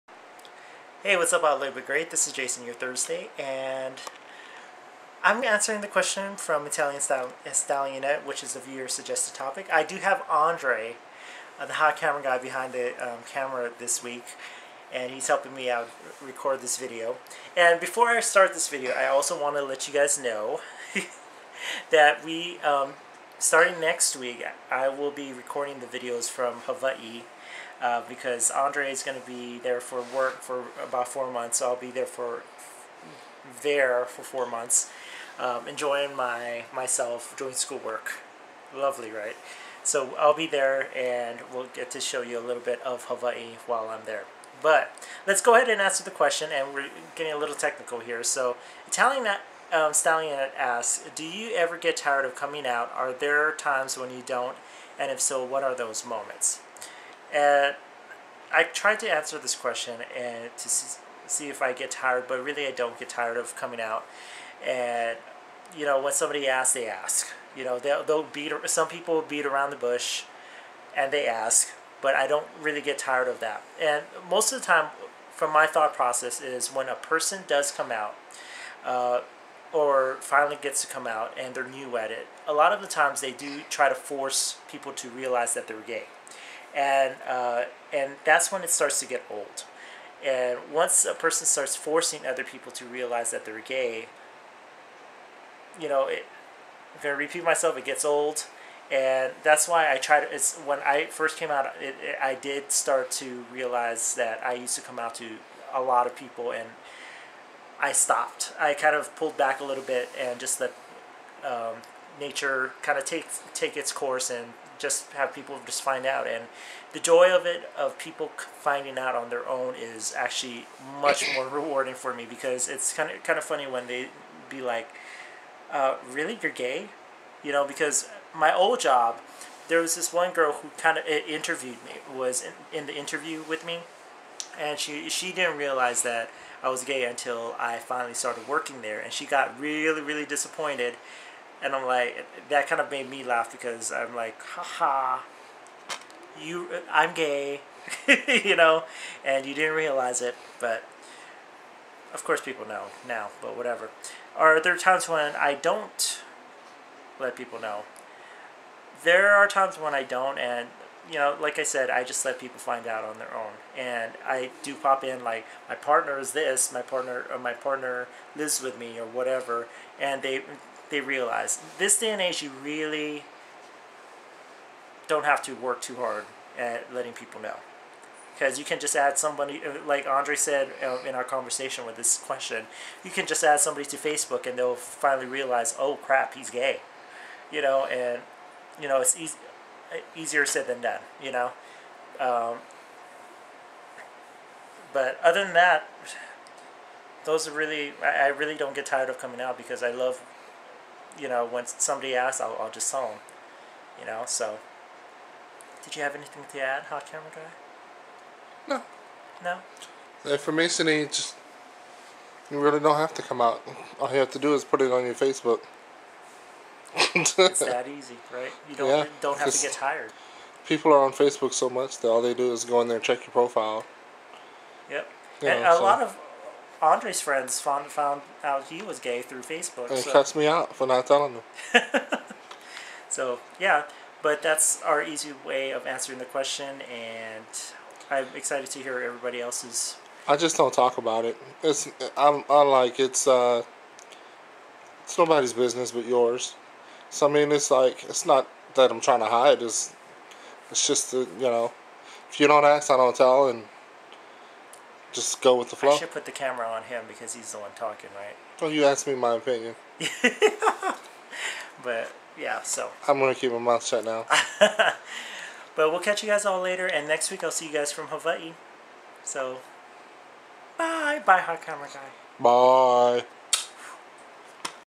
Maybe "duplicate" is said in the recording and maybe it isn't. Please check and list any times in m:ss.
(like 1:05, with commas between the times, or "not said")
not said.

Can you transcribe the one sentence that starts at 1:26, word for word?
And, uh, and that's when it starts to get old.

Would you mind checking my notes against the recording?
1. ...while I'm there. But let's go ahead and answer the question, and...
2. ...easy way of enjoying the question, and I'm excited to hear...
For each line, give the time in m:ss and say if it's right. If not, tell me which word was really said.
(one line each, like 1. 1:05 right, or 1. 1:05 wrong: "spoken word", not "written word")
1. 0:43 right
2. 3:55 wrong: "answering", not "enjoying".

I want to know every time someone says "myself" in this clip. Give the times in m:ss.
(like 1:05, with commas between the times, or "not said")
0:36, 1:37.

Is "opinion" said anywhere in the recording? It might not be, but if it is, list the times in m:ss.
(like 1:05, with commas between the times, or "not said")
4:19.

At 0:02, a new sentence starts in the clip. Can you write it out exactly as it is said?
This is Jason, your Thursday, and I'm answering the question from Italian Stall- Stallionette, which is the viewer suggested topic.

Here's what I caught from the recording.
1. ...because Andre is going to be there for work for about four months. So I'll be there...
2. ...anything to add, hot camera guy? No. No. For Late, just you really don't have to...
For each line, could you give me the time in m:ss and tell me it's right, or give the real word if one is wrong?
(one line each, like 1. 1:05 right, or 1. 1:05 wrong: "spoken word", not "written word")
1. 0:28 right
2. 3:26 wrong: "Masonry", not "Late".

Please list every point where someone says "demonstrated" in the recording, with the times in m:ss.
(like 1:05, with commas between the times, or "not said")
not said.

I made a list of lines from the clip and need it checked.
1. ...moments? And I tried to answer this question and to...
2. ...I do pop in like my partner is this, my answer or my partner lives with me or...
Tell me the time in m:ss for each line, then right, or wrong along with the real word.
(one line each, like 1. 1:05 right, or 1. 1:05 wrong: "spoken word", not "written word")
1. 0:56 right
2. 2:44 wrong: "partner", not "answer".